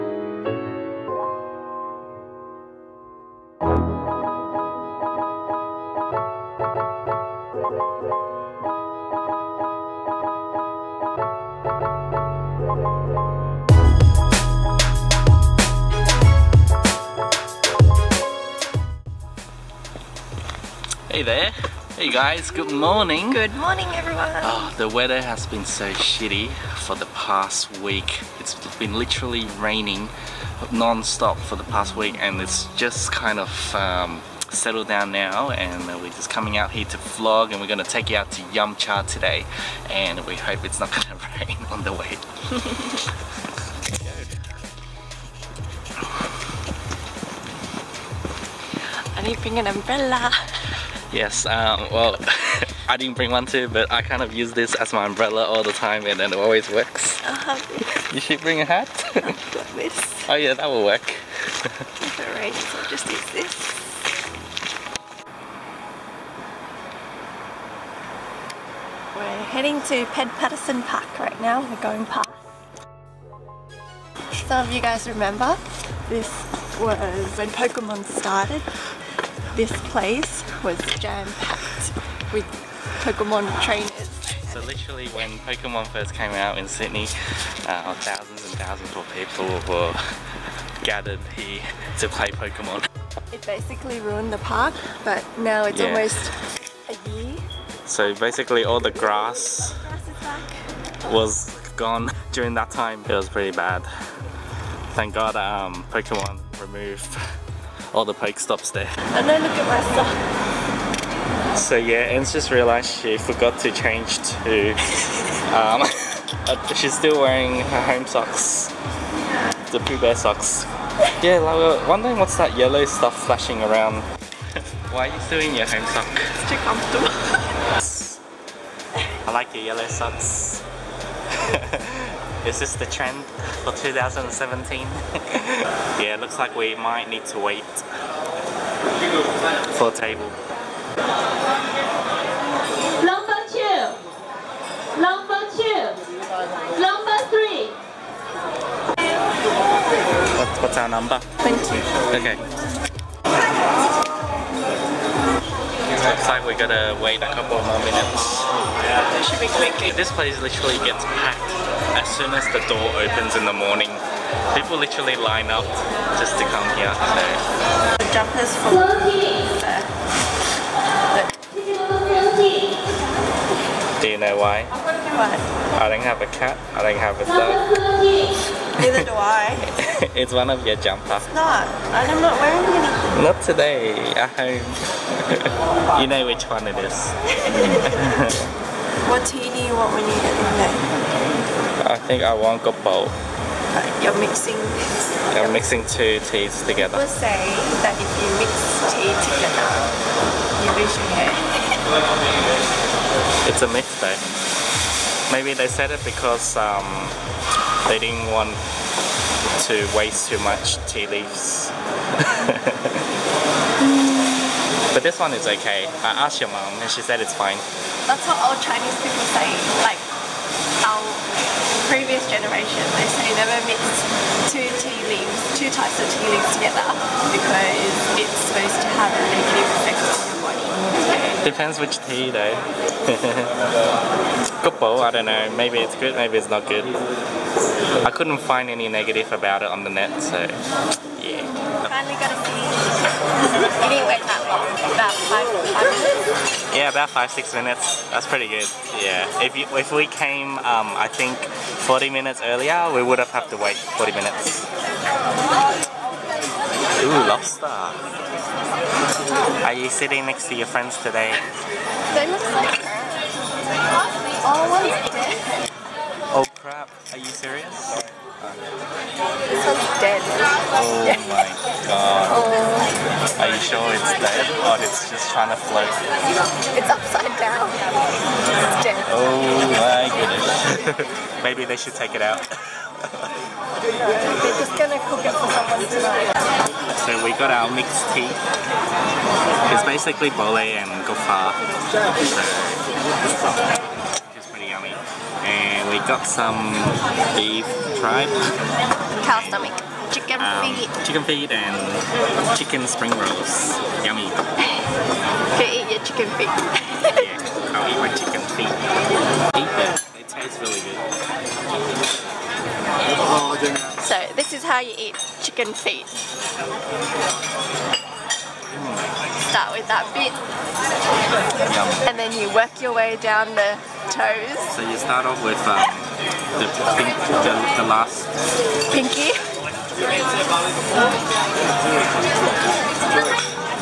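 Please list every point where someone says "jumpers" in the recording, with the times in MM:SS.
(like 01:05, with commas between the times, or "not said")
02:48, 03:00.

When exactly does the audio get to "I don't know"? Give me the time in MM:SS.
03:55.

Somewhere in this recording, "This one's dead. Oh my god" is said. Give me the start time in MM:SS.
04:29.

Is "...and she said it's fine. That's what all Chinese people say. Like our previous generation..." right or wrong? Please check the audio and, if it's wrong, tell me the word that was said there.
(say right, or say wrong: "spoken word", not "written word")
right.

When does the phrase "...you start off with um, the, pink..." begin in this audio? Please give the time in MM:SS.
05:24.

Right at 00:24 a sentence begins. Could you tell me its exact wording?
Oh, the weather has been so shitty for the past week.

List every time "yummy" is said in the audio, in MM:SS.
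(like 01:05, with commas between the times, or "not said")
04:54, 05:04.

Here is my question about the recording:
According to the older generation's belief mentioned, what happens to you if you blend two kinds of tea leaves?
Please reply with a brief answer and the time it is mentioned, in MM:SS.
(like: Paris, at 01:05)
You lose your hair, at 03:20.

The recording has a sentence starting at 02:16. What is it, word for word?
yeah, looks like we might need to wait for a table.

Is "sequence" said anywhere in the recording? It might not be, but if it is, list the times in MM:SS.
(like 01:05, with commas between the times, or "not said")
not said.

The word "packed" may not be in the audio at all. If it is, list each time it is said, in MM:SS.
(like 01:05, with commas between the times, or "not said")
01:20, 02:41.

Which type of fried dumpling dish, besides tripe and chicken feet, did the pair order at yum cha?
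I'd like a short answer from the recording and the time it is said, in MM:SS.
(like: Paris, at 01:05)
Chicken spring rolls, at 05:02.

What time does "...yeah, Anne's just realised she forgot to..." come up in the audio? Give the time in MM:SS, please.
01:51.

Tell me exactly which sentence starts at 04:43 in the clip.
they're just gonna cook it for someone tonight so we got our mixed tea.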